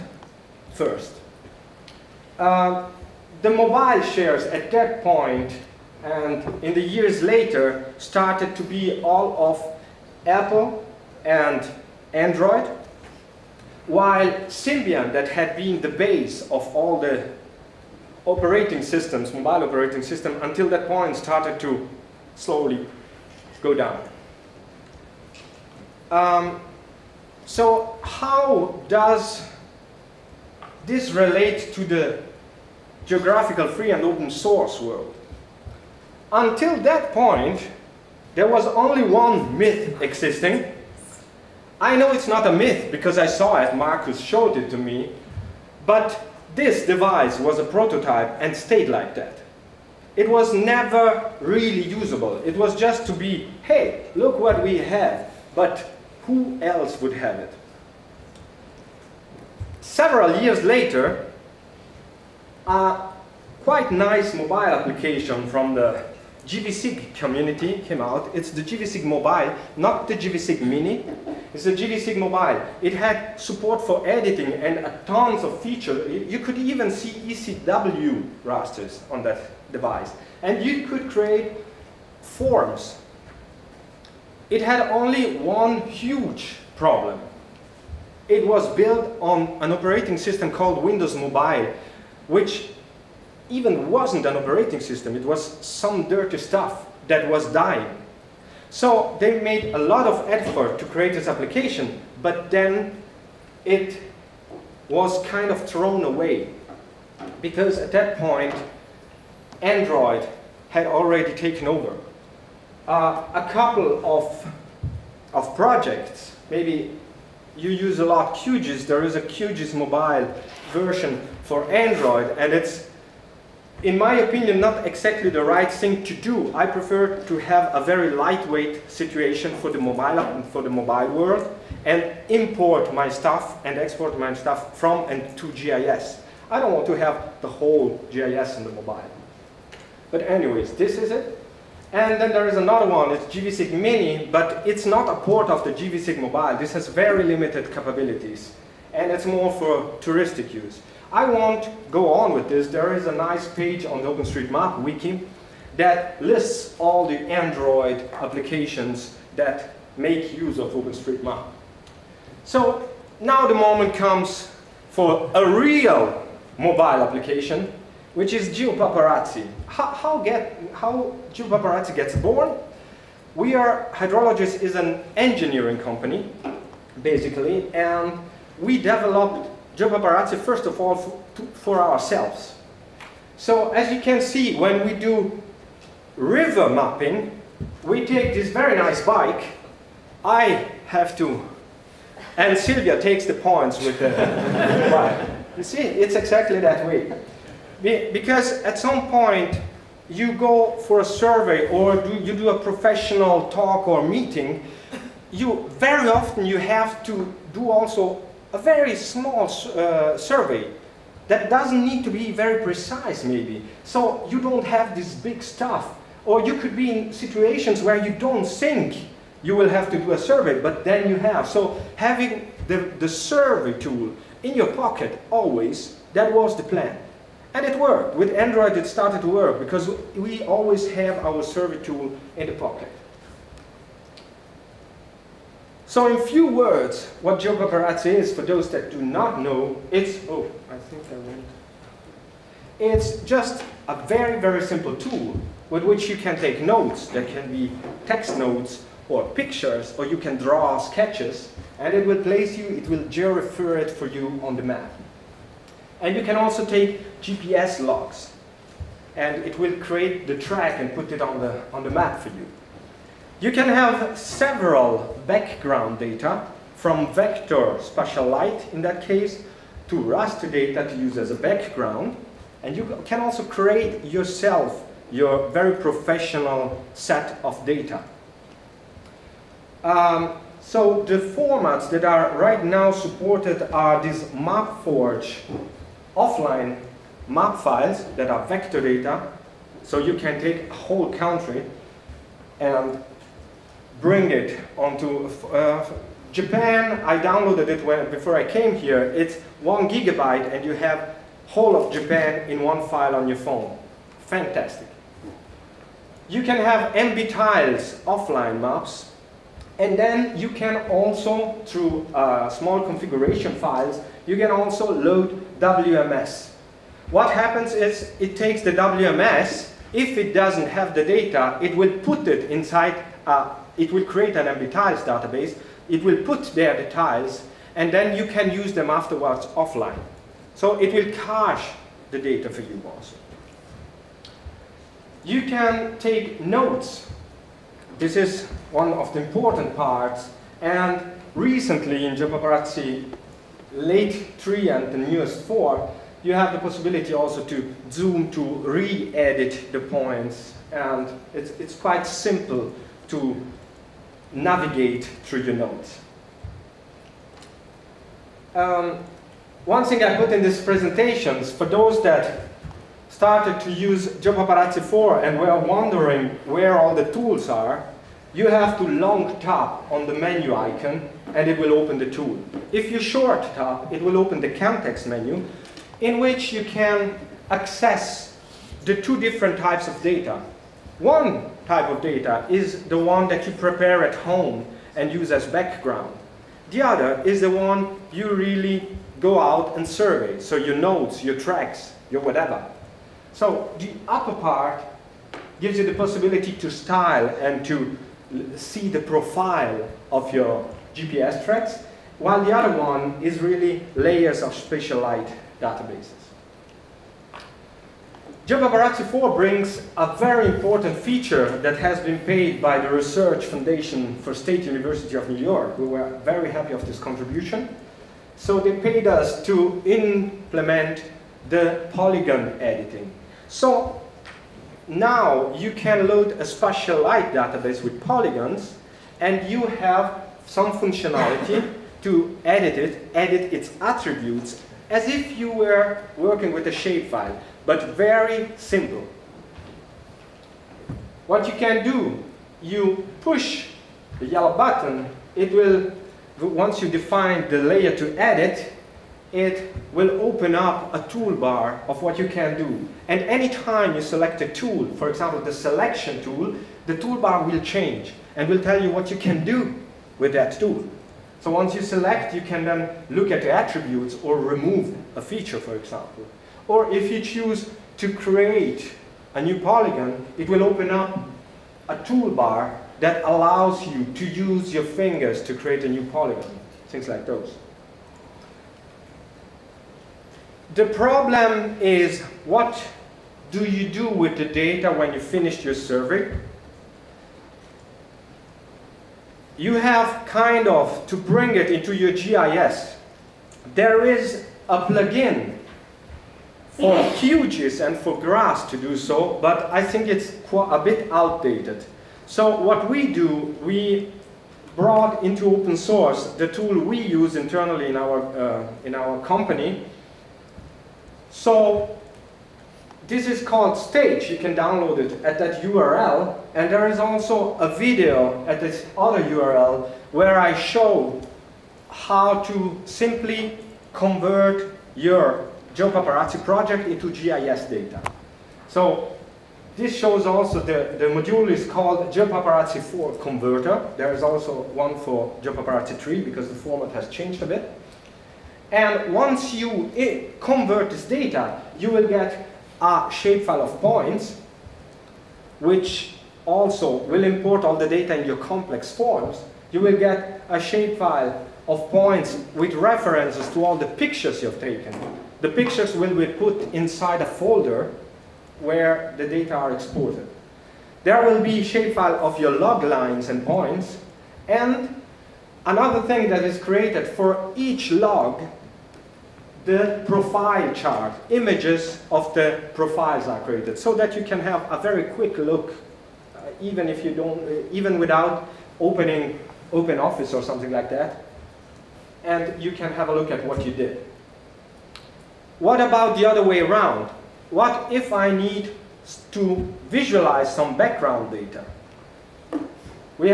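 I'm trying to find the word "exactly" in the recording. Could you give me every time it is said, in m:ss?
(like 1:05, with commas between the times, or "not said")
2:04, 3:16.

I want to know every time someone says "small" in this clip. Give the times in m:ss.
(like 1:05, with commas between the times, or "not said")
3:28, 5:12.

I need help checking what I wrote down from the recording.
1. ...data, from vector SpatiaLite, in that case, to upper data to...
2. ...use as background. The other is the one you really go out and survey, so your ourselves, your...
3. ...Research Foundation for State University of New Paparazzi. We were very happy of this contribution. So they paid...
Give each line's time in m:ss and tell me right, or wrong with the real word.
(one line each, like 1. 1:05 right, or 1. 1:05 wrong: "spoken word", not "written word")
1. 4:25 wrong: "raster", not "upper"
2. 6:25 wrong: "notes", not "ourselves"
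3. 6:52 wrong: "York", not "Paparazzi".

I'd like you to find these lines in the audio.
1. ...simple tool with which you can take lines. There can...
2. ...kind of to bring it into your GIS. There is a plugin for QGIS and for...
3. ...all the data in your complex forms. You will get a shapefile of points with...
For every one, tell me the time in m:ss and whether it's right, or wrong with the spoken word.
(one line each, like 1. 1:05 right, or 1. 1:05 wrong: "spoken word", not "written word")
1. 4:04 wrong: "notes", not "lines"
2. 8:10 right
3. 9:07 right.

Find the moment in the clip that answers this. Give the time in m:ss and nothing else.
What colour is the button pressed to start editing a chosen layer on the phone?
7:24.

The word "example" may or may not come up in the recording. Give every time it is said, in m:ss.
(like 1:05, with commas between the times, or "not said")
7:35, 7:45.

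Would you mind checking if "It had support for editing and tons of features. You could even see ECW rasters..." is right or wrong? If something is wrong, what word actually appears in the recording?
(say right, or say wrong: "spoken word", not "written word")
right.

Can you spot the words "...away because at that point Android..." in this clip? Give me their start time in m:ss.
1:46.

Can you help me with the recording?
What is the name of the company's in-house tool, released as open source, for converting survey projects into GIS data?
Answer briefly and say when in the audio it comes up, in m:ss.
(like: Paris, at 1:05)
Stage, at 8:33.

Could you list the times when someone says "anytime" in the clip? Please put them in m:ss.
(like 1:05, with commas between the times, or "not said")
7:33.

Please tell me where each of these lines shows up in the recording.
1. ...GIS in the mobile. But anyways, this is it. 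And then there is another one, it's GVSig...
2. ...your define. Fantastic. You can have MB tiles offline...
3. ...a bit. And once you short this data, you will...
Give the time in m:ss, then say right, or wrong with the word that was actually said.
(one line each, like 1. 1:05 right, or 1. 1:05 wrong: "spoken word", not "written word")
1. 2:18 right
2. 5:03 wrong: "phone", not "define"
3. 8:57 wrong: "convert", not "short".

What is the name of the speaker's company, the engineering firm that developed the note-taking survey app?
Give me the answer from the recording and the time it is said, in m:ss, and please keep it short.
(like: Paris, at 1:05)
HydroloGIS, at 2:53.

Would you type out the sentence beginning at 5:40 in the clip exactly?
And recently in Geopaparazzi, late 3 and the newest 4, you have the possibility also to zoom to re-edit the points.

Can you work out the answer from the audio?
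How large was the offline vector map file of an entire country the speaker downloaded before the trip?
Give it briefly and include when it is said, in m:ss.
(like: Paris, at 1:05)
1 gigabyte, at 4:59.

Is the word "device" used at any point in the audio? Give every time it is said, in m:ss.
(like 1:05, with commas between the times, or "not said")
0:46, 1:19.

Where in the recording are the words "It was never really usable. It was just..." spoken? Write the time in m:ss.
0:50.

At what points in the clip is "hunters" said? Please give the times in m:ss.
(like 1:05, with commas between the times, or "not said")
not said.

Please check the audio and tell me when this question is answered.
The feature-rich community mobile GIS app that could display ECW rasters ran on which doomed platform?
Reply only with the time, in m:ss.
1:30.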